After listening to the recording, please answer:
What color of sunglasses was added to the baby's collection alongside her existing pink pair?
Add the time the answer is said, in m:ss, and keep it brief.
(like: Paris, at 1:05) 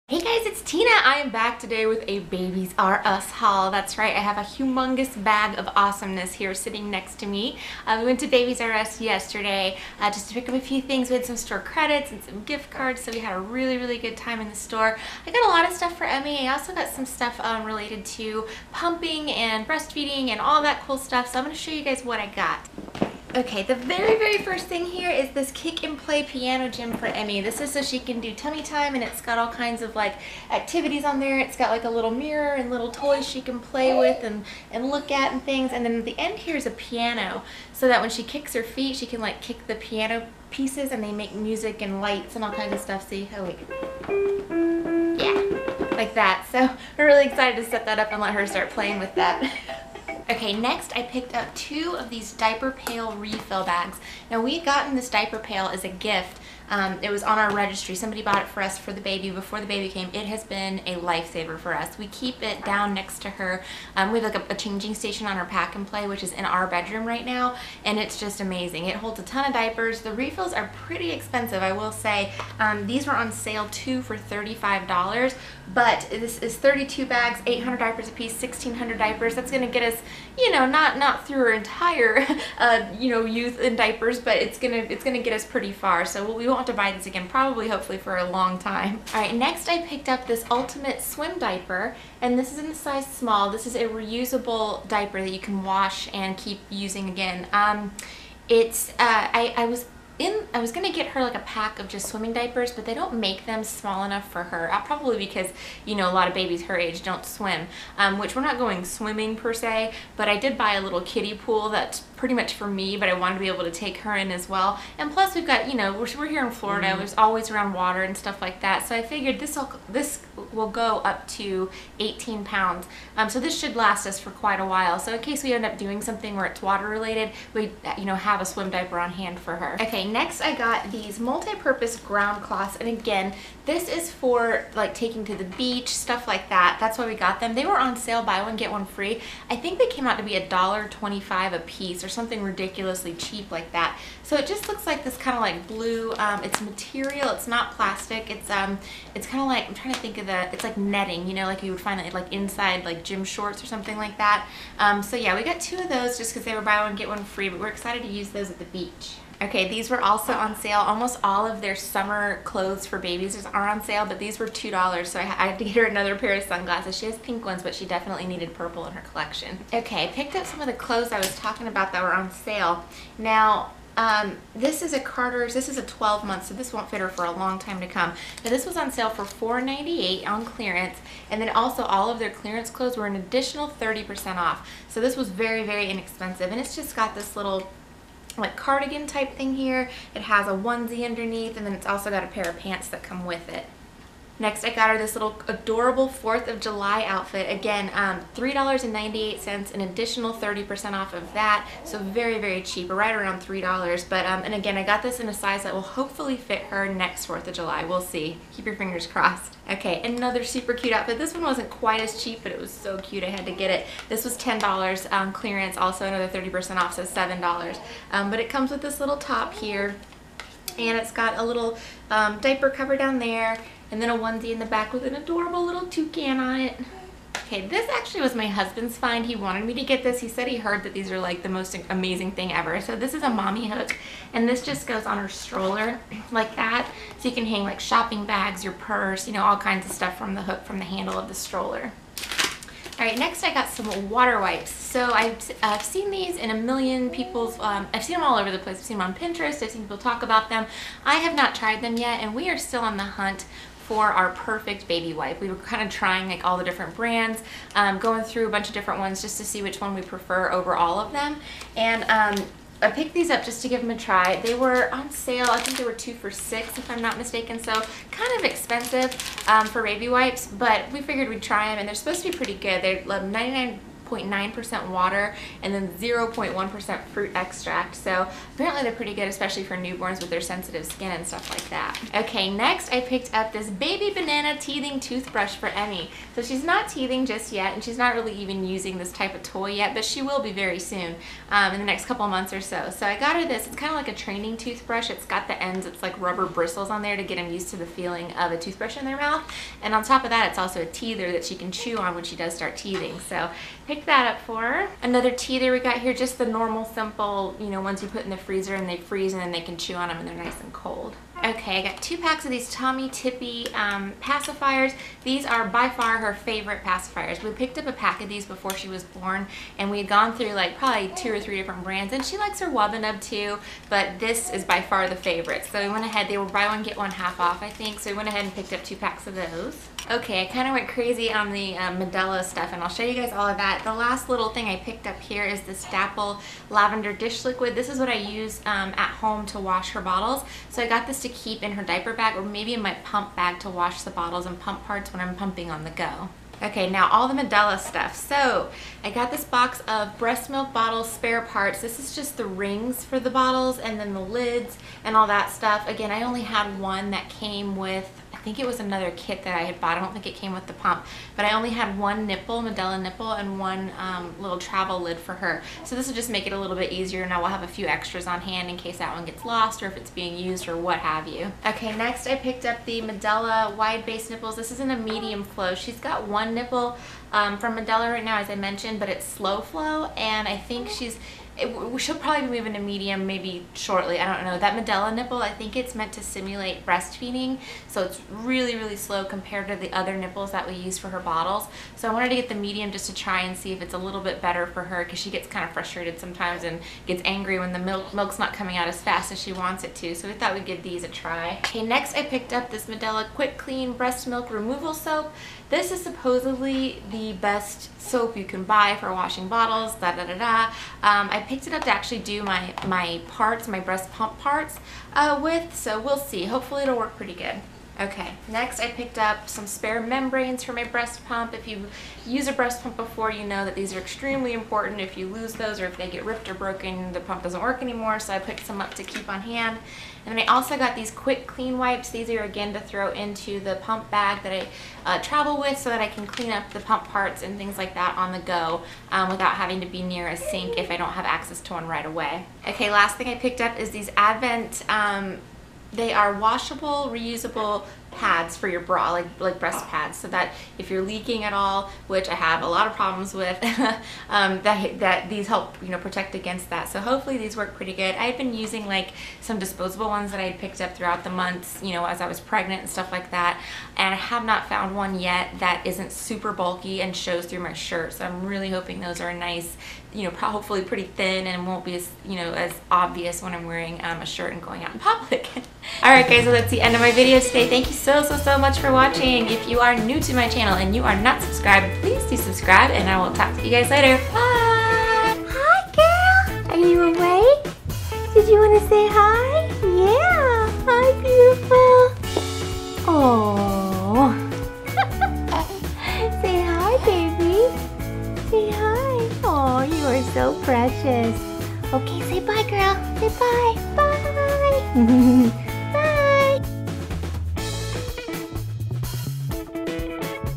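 Purple, at 2:48.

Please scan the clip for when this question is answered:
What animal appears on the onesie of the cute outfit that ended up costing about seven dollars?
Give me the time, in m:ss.
3:45.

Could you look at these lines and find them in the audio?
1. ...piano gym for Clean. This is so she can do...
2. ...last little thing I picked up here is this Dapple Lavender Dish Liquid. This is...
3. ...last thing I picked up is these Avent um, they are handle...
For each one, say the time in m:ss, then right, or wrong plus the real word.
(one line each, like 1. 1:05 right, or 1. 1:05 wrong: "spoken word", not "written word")
1. 0:26 wrong: "Emmy", not "Clean"
2. 5:33 right
3. 7:22 wrong: "washable", not "handle".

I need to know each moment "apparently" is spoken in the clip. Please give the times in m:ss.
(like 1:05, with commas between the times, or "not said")
4:38.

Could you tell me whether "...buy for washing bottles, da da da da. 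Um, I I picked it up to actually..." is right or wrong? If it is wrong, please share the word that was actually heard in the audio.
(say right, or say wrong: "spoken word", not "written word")
right.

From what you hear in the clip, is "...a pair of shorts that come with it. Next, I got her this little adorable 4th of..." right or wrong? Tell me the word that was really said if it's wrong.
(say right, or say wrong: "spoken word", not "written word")
wrong: "pants", not "shorts".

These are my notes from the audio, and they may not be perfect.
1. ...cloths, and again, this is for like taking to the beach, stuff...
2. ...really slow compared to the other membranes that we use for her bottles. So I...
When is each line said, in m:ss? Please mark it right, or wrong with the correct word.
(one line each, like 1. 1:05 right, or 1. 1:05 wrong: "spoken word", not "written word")
1. 2:12 right
2. 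6:28 wrong: "nipples", not "membranes".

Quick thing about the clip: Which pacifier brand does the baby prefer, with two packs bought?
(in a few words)
Tommee Tippee.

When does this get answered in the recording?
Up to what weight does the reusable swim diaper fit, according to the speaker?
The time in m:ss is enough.
2:01.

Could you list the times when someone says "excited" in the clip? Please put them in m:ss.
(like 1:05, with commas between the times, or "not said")
0:47, 2:37.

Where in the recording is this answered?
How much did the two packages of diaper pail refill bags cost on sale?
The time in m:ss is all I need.
1:14.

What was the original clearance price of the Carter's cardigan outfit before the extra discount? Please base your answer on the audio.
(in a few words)
$4.98.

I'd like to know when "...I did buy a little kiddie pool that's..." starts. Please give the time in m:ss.
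1:50.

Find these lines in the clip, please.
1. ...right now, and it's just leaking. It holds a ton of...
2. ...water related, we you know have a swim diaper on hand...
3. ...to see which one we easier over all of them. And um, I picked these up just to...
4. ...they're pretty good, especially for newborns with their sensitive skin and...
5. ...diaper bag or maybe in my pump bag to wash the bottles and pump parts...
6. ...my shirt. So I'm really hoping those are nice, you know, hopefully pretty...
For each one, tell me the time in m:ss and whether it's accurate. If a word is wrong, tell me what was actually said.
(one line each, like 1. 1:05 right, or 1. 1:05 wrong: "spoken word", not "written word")
1. 1:07 wrong: "amazing", not "leaking"
2. 2:06 right
3. 4:19 wrong: "prefer", not "easier"
4. 4:38 right
5. 5:41 right
6. 7:47 right.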